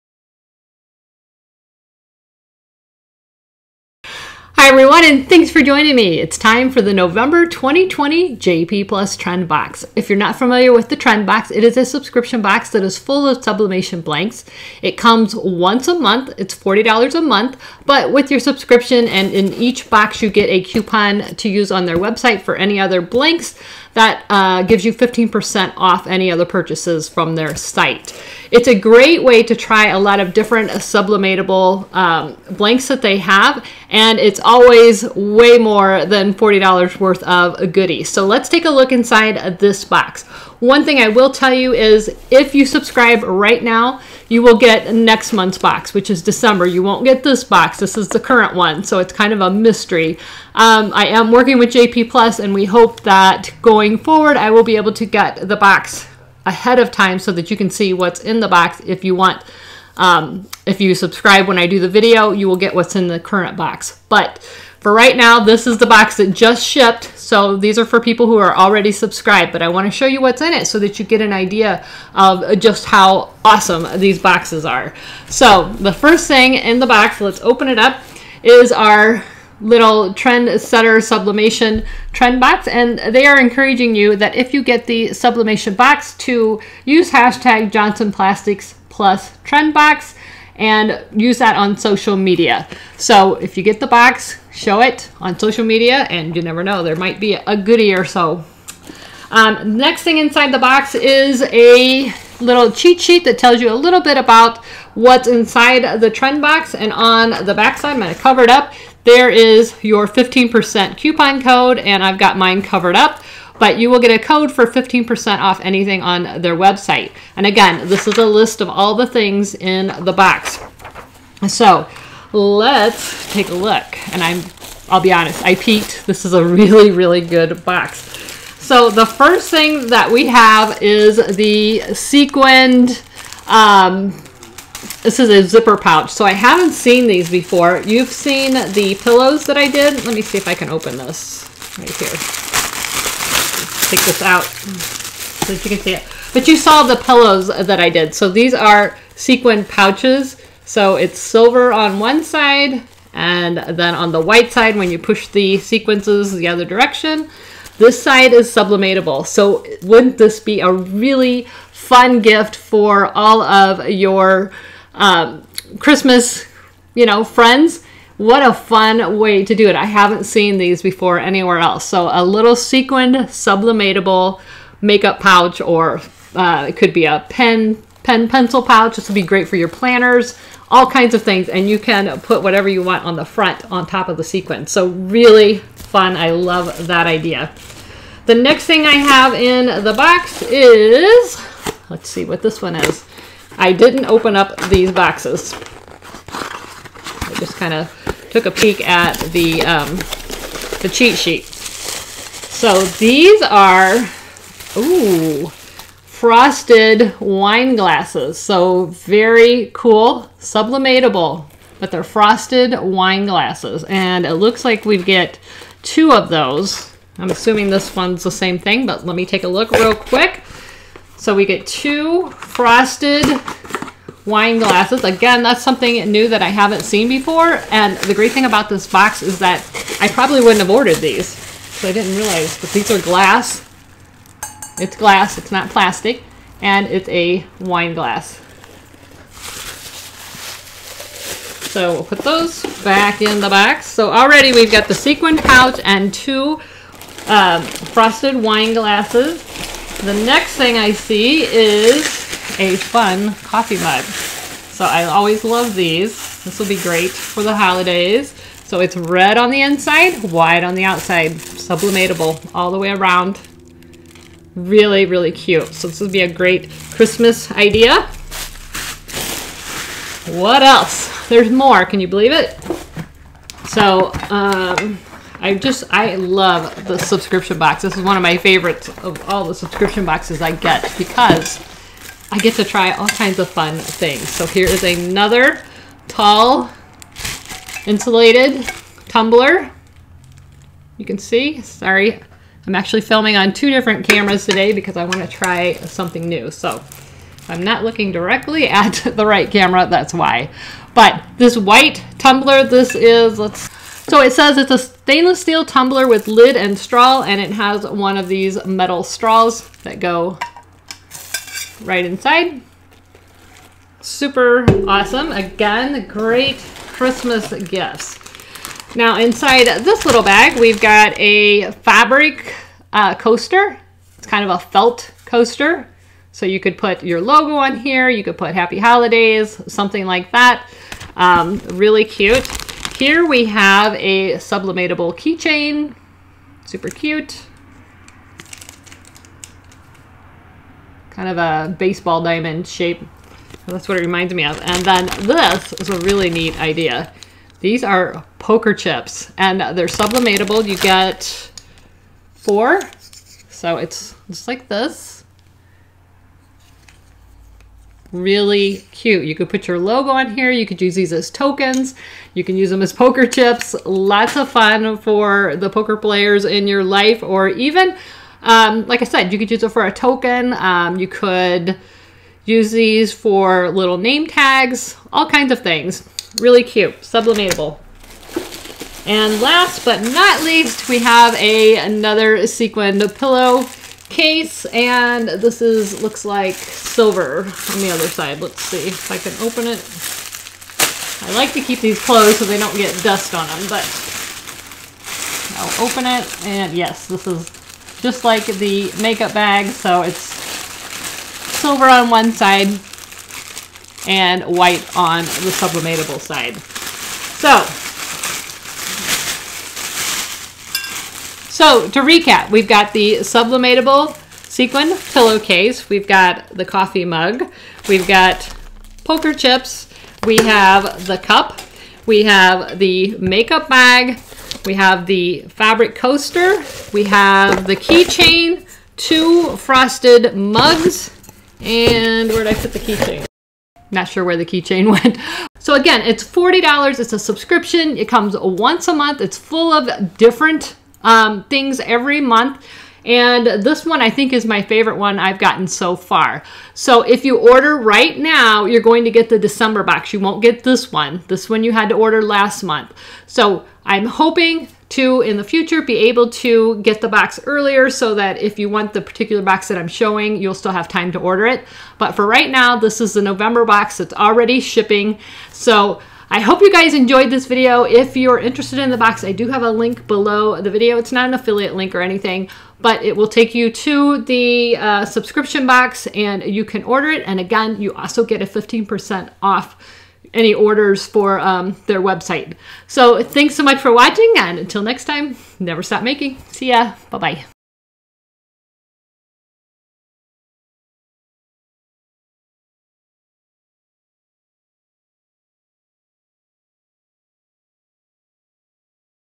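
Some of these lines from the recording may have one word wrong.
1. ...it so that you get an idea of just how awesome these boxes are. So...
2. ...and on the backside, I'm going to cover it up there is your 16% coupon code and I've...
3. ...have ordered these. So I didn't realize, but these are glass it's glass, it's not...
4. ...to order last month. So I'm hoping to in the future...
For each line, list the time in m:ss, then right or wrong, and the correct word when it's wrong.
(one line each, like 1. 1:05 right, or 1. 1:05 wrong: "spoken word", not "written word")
1. 1:10 right
2. 1:46 wrong: "15", not "16"
3. 3:50 right
4. 7:31 right.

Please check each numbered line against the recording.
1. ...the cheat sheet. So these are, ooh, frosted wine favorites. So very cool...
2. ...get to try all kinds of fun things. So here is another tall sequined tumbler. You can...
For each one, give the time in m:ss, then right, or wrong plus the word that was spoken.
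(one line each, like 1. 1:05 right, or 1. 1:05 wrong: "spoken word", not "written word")
1. 3:20 wrong: "glasses", not "favorites"
2. 4:42 wrong: "insulated", not "sequined".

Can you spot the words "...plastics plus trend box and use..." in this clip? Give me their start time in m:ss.
1:28.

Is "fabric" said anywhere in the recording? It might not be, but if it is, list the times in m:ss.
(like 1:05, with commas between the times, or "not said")
5:21, 7:05.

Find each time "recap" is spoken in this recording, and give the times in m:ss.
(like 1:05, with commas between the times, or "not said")
6:52.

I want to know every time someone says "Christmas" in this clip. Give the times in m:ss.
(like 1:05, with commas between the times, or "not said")
2:45, 4:26, 5:16.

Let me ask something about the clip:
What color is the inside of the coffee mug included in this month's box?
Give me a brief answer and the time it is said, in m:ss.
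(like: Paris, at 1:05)
Red, at 4:18.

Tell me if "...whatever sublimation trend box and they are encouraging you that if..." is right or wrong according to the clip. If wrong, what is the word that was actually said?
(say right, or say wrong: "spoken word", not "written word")
wrong: "setter", not "whatever".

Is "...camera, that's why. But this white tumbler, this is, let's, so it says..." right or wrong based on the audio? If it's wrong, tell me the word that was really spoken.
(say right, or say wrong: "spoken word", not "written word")
right.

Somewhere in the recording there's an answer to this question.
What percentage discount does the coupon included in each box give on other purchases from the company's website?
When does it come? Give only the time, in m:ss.
0:24.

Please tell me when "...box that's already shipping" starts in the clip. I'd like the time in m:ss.
7:43.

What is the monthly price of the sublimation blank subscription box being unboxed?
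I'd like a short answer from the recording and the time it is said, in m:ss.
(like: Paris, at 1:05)
$40, at 0:16.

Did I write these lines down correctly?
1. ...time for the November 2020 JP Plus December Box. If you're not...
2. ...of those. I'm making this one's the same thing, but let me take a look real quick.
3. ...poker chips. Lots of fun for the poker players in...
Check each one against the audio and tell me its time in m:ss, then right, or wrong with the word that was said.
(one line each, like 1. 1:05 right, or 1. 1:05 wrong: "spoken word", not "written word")
1. 0:06 wrong: "Trend", not "December"
2. 3:36 wrong: "assuming", not "making"
3. 6:02 right.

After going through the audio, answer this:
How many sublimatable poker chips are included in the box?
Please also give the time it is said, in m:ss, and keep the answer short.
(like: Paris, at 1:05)
4, at 5:50.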